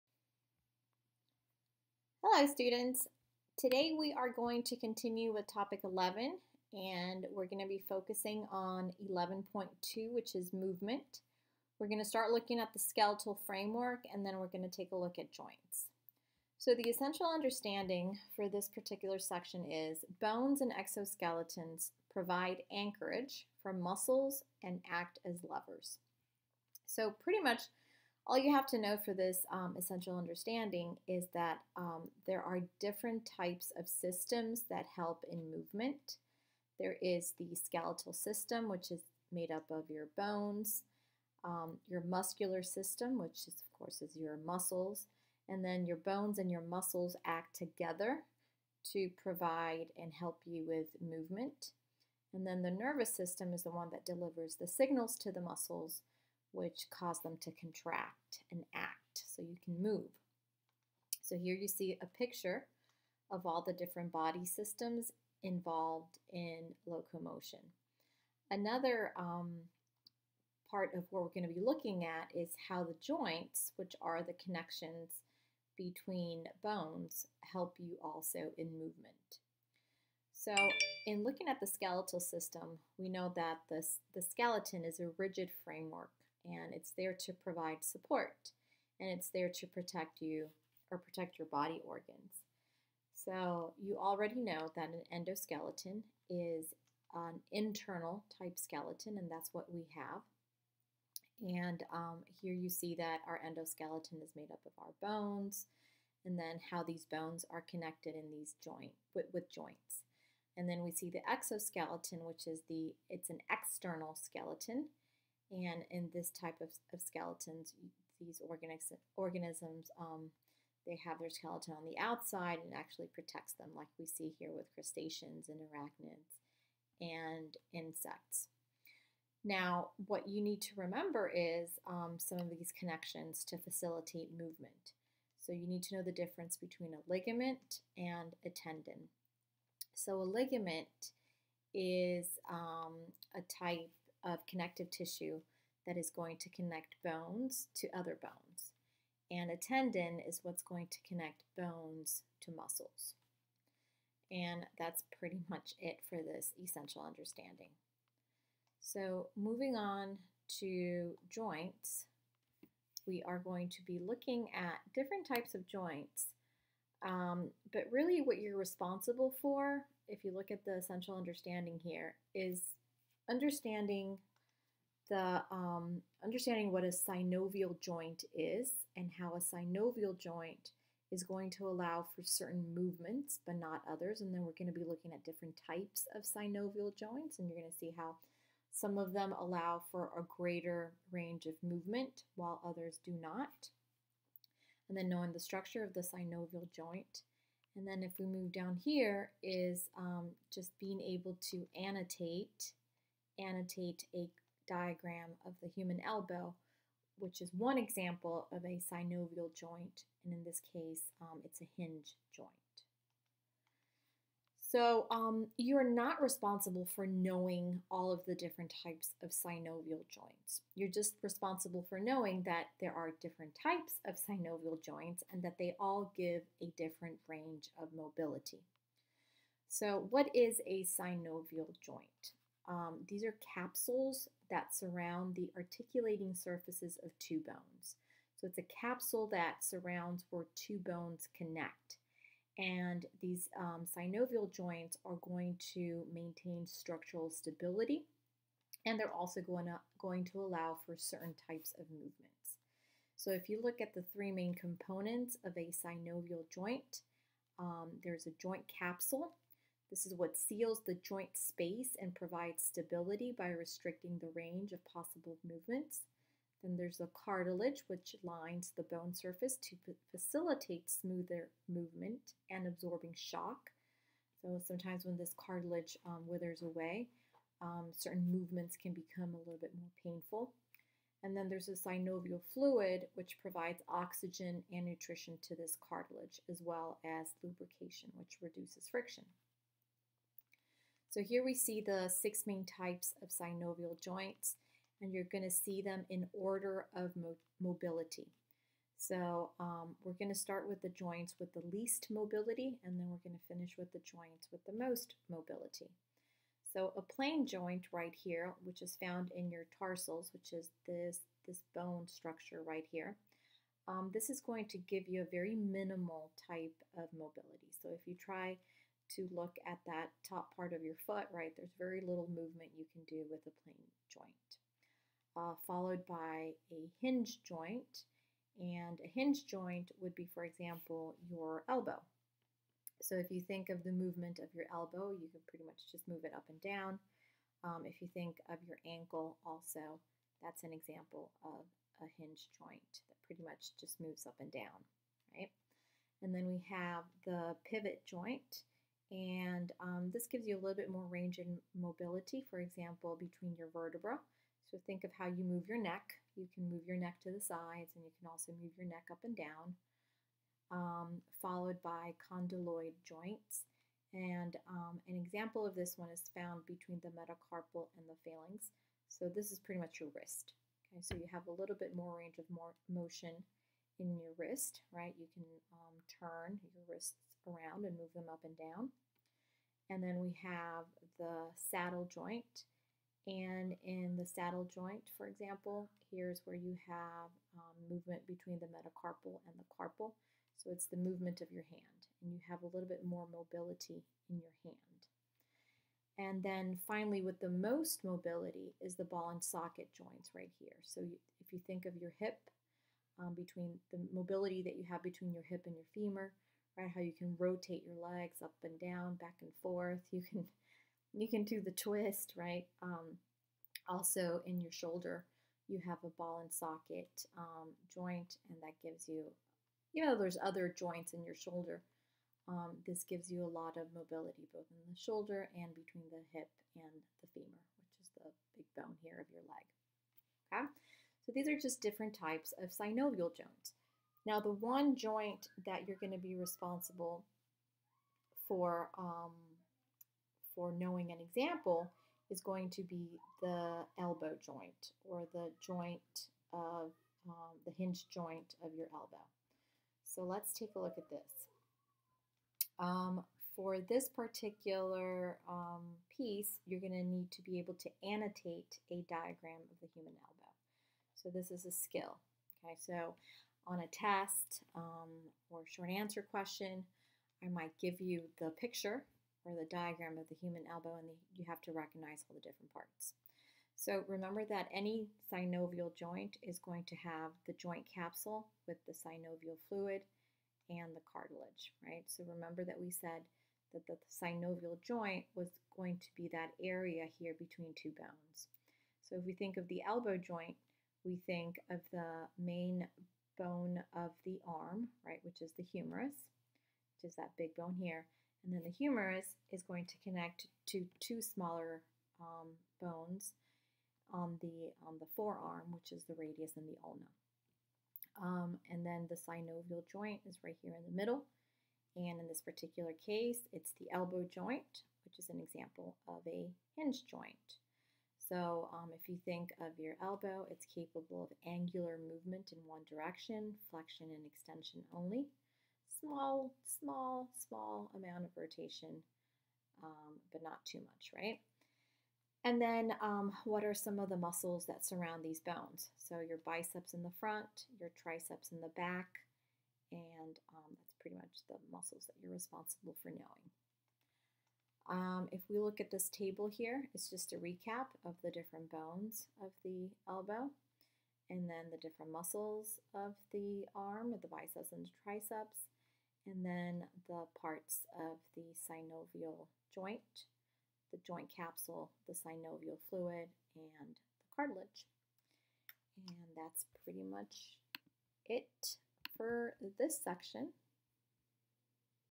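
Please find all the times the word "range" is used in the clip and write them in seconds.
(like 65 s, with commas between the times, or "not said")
191 s, 227 s, 264 s, 351 s, 372 s.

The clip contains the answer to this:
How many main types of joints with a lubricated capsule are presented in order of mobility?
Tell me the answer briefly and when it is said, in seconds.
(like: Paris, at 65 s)
6, at 292 s.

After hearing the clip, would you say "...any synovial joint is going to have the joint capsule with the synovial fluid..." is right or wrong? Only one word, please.
right.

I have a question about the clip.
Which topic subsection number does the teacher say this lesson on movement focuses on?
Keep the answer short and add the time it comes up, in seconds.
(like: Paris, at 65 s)
11.2, at 9 s.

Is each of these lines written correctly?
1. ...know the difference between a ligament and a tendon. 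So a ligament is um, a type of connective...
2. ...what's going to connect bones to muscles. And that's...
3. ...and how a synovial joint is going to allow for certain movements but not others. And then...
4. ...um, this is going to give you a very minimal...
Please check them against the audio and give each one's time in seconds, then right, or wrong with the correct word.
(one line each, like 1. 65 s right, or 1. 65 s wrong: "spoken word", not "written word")
1. 135 s right
2. 150 s right
3. 178 s right
4. 313 s right.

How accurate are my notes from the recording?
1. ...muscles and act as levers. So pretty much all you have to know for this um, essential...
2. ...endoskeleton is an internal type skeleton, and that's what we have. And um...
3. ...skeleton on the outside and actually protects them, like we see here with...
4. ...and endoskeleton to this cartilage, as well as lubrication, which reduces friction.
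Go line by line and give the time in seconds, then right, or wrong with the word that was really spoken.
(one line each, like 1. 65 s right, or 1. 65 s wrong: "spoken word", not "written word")
1. 23 s right
2. 95 s right
3. 121 s right
4. 284 s wrong: "nutrition", not "endoskeleton".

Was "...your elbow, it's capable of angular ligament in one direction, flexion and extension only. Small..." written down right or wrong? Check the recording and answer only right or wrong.
wrong.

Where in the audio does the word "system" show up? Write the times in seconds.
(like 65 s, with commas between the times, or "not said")
33 s, 38 s, 42 s, 53 s, 64 s, 82 s.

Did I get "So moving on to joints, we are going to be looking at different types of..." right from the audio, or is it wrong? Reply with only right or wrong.
right.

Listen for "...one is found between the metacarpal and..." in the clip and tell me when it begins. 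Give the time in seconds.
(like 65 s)
365 s.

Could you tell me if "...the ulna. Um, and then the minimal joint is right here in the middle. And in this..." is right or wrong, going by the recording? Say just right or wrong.
wrong.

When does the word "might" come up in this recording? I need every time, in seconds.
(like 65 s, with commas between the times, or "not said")
467 s.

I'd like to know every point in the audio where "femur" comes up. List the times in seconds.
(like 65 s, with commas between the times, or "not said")
405 s, 427 s.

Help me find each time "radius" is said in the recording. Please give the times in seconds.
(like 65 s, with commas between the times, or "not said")
506 s.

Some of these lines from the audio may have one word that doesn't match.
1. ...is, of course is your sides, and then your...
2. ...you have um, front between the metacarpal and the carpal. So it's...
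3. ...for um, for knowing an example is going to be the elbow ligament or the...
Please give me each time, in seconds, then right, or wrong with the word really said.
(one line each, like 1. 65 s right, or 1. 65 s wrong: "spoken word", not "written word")
1. 43 s wrong: "muscles", not "sides"
2. 386 s wrong: "movement", not "front"
3. 438 s wrong: "joint", not "ligament".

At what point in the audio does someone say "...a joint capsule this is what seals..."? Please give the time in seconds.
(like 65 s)
258 s.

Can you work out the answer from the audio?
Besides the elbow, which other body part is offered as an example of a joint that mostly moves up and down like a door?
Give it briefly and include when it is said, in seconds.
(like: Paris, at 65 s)
Ankle, at 338 s.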